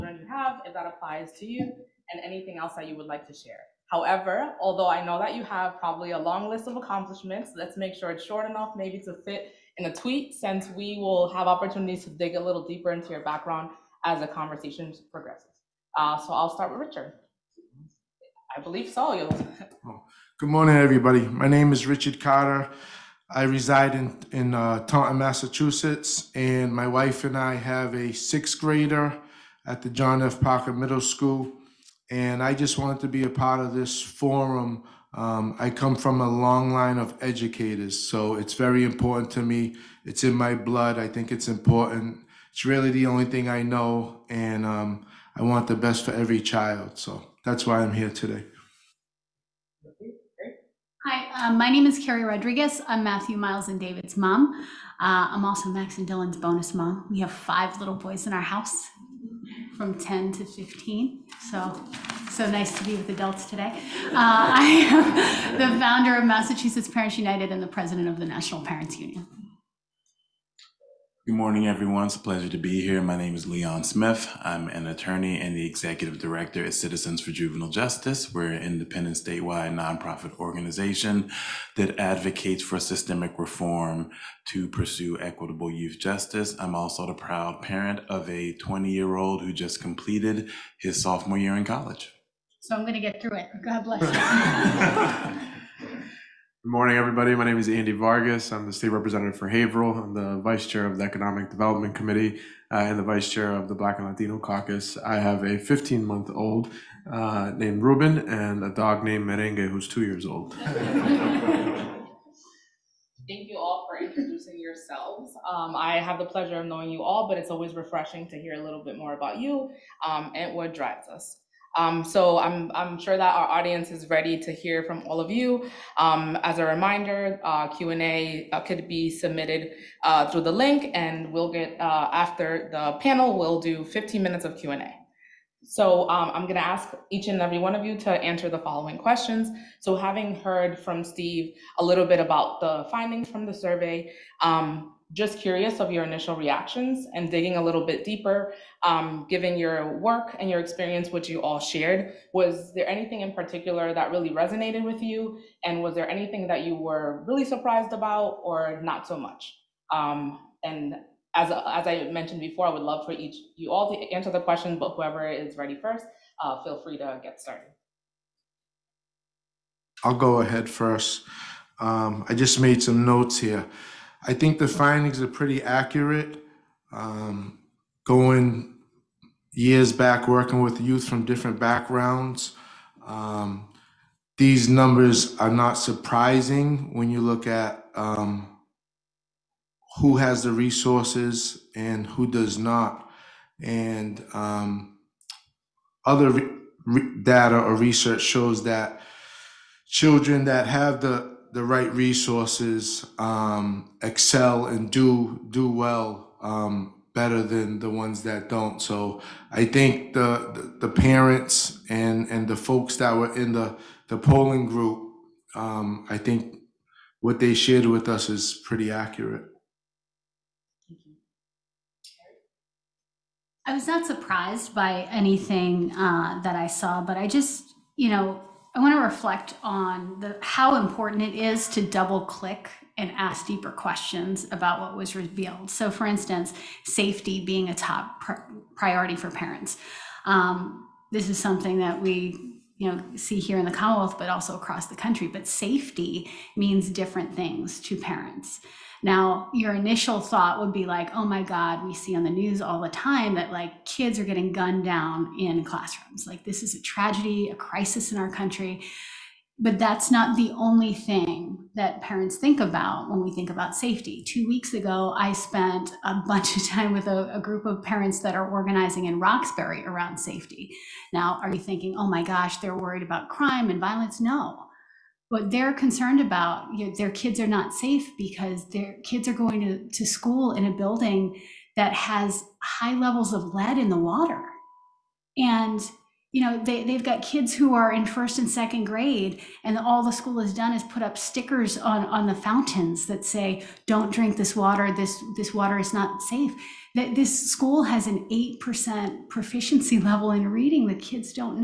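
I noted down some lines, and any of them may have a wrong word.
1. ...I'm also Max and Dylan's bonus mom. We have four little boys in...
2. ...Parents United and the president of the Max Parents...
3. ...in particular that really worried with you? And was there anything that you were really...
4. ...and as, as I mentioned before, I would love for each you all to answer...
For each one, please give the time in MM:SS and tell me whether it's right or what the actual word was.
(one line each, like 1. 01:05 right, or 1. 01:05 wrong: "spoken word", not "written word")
1. 00:55 wrong: "five", not "four"
2. 01:06 wrong: "National", not "Max"
3. 02:33 wrong: "resonated", not "worried"
4. 02:40 right.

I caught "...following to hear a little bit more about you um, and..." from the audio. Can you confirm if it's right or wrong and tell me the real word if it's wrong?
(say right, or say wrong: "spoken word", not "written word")
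wrong: "refreshing", not "following".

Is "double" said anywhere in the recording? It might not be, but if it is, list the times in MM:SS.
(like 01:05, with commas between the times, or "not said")
03:51.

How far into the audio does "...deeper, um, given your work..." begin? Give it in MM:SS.
02:28.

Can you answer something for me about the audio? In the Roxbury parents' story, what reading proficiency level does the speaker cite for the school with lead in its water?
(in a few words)
8%.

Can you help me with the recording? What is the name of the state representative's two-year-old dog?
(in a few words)
Merengue.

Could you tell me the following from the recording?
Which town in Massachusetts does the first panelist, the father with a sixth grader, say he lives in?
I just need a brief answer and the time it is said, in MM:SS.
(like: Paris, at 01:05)
Taunton, at 00:24.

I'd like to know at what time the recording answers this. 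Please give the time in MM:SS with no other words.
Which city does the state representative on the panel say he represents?
01:39.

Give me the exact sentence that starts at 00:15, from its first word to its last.
Uh, so I'll start with Richard.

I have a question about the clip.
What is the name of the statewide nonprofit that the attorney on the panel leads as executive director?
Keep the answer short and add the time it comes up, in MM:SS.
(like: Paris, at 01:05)
Citizens for Juvenile Justice, at 01:16.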